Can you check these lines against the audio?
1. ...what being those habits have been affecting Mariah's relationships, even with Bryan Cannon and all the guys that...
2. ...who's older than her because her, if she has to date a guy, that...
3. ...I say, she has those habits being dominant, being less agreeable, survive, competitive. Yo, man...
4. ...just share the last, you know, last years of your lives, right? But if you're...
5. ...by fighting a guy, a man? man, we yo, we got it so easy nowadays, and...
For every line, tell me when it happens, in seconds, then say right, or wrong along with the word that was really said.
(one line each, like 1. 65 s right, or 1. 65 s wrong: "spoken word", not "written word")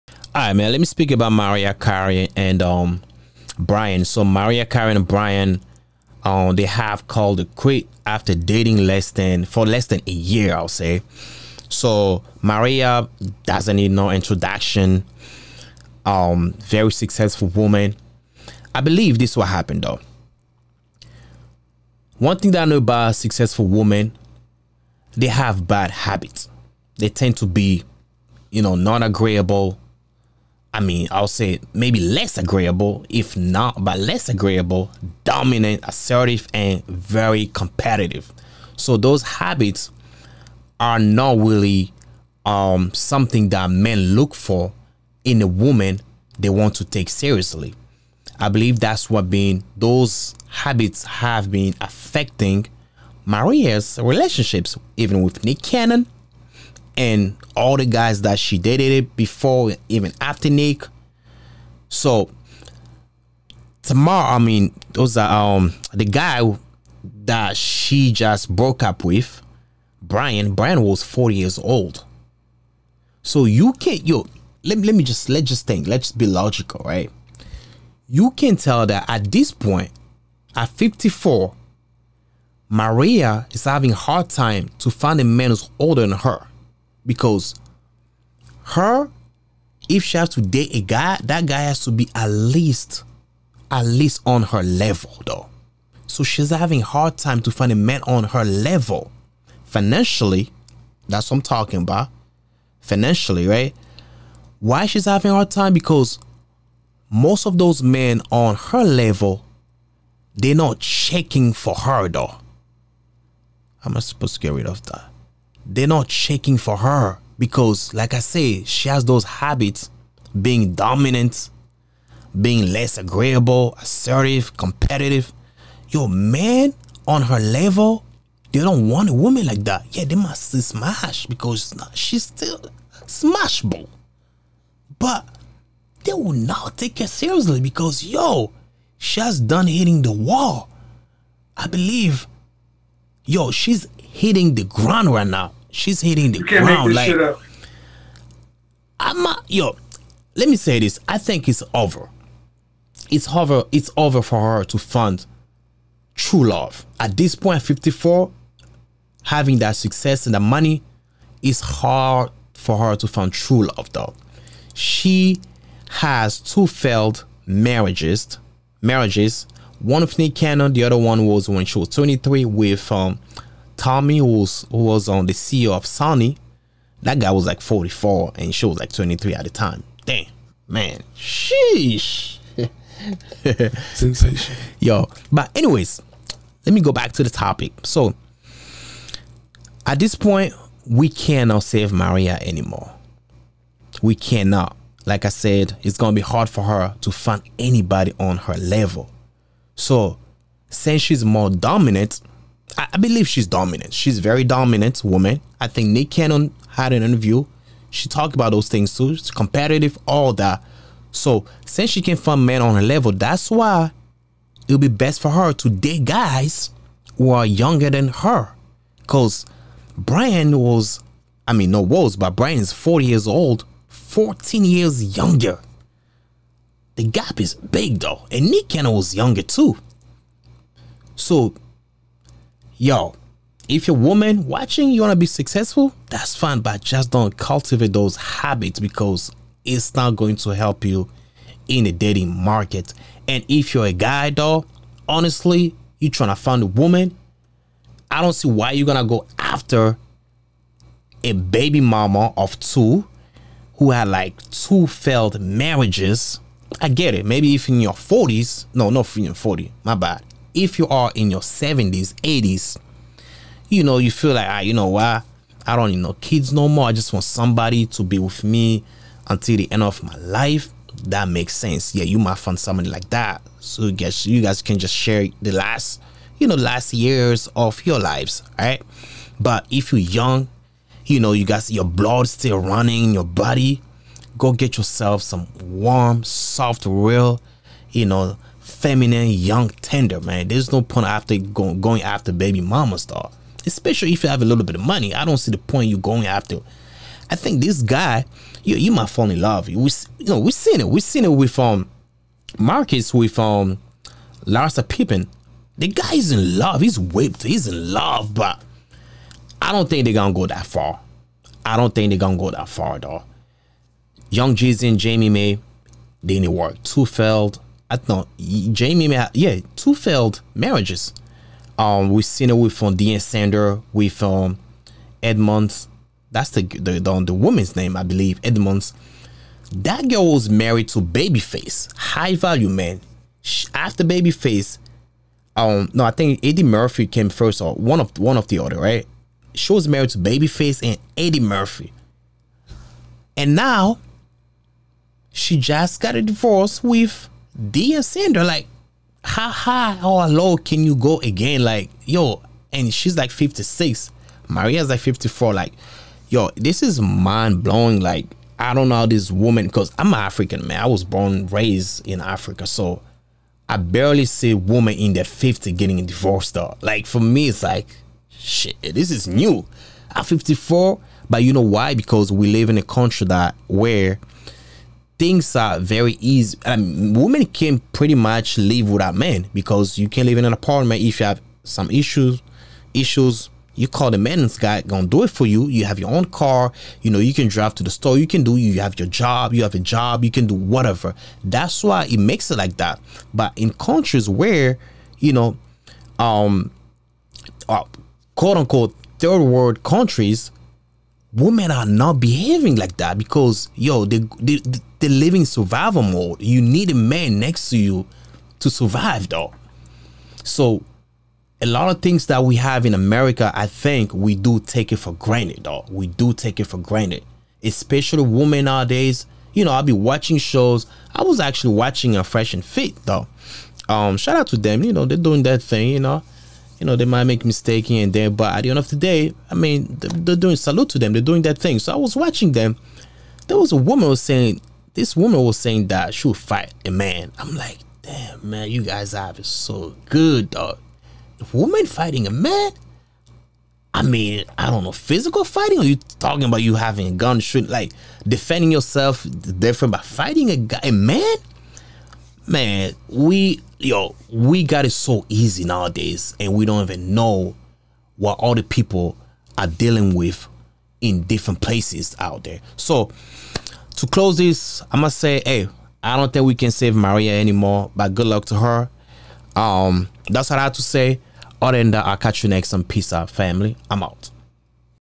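1. 49 s wrong: "Nick", not "Bryan"
2. 85 s right
3. 118 s wrong: "assertive", not "survive"
4. 274 s right
5. 449 s right.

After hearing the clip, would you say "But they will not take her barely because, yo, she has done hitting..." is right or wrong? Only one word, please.
wrong.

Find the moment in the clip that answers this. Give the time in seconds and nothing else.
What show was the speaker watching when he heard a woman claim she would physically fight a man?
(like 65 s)
422 s.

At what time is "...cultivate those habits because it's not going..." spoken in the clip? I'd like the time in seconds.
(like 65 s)
237 s.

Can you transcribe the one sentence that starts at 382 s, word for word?
Issues you call the maintenance guy gonna do it for you.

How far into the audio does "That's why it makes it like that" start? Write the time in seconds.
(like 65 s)
391 s.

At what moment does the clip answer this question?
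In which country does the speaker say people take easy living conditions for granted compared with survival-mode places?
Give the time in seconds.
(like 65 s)
412 s.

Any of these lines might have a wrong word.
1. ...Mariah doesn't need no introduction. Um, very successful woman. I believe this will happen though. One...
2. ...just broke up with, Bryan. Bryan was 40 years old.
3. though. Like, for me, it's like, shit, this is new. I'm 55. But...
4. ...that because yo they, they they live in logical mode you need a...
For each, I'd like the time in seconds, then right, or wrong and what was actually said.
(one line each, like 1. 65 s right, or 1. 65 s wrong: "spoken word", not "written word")
1. 12 s right
2. 68 s right
3. 366 s wrong: "54", not "55"
4. 402 s wrong: "survival", not "logical".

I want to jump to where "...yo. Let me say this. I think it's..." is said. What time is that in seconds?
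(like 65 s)
149 s.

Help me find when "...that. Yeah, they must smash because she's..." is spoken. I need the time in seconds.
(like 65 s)
129 s.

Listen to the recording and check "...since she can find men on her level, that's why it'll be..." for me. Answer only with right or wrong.
right.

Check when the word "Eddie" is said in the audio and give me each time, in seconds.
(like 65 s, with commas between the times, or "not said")
336 s, 341 s.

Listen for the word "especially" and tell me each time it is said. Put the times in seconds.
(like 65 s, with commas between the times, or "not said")
293 s, 417 s.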